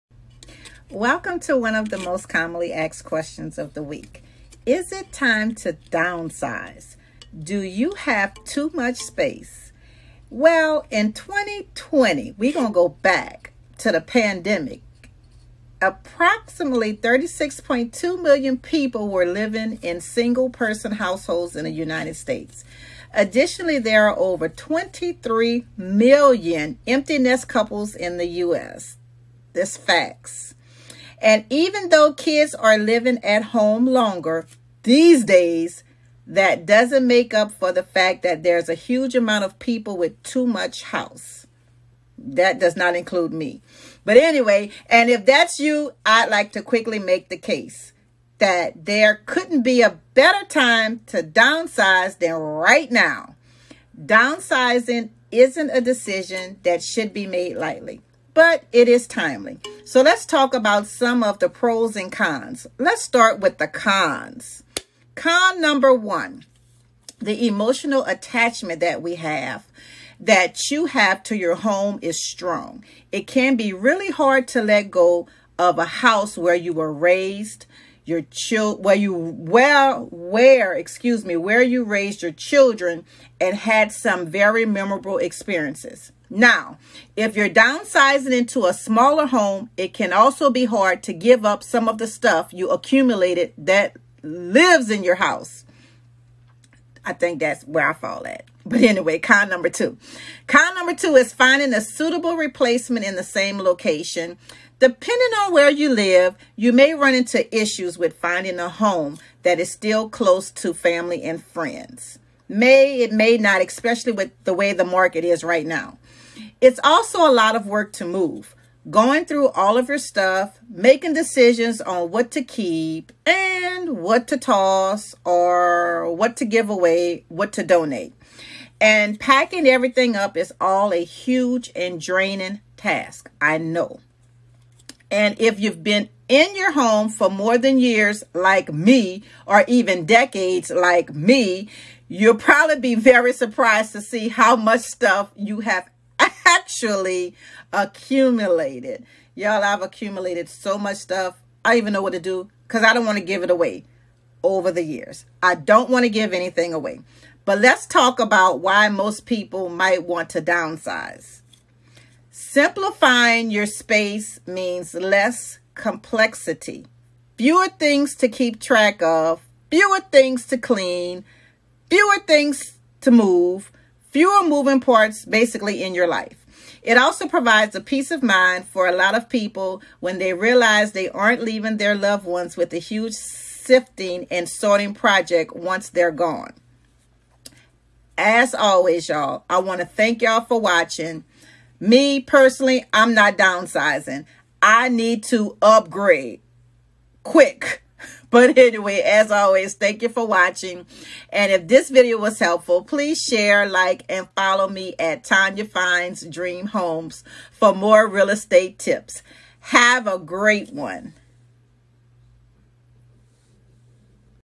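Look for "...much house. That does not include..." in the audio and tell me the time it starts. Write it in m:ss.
0:40.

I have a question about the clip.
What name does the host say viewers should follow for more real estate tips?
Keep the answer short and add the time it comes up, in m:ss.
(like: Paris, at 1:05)
Tanya Finds Dream Homes, at 3:25.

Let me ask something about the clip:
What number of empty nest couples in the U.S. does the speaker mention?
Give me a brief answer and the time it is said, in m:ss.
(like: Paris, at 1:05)
over 23 million, at 0:24.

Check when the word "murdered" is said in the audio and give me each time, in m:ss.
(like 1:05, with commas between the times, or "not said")
not said.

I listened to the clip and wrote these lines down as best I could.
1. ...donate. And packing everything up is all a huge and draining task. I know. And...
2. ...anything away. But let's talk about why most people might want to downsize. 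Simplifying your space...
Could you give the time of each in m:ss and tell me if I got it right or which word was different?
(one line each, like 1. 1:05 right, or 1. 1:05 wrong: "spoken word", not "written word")
1. 2:07 right
2. 2:36 right.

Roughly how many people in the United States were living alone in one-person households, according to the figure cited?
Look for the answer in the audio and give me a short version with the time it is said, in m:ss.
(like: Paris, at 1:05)
36.2 million, at 0:16.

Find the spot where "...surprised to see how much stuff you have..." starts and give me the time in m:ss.
2:23.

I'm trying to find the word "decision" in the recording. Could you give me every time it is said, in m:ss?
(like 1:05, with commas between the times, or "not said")
0:55, 2:01.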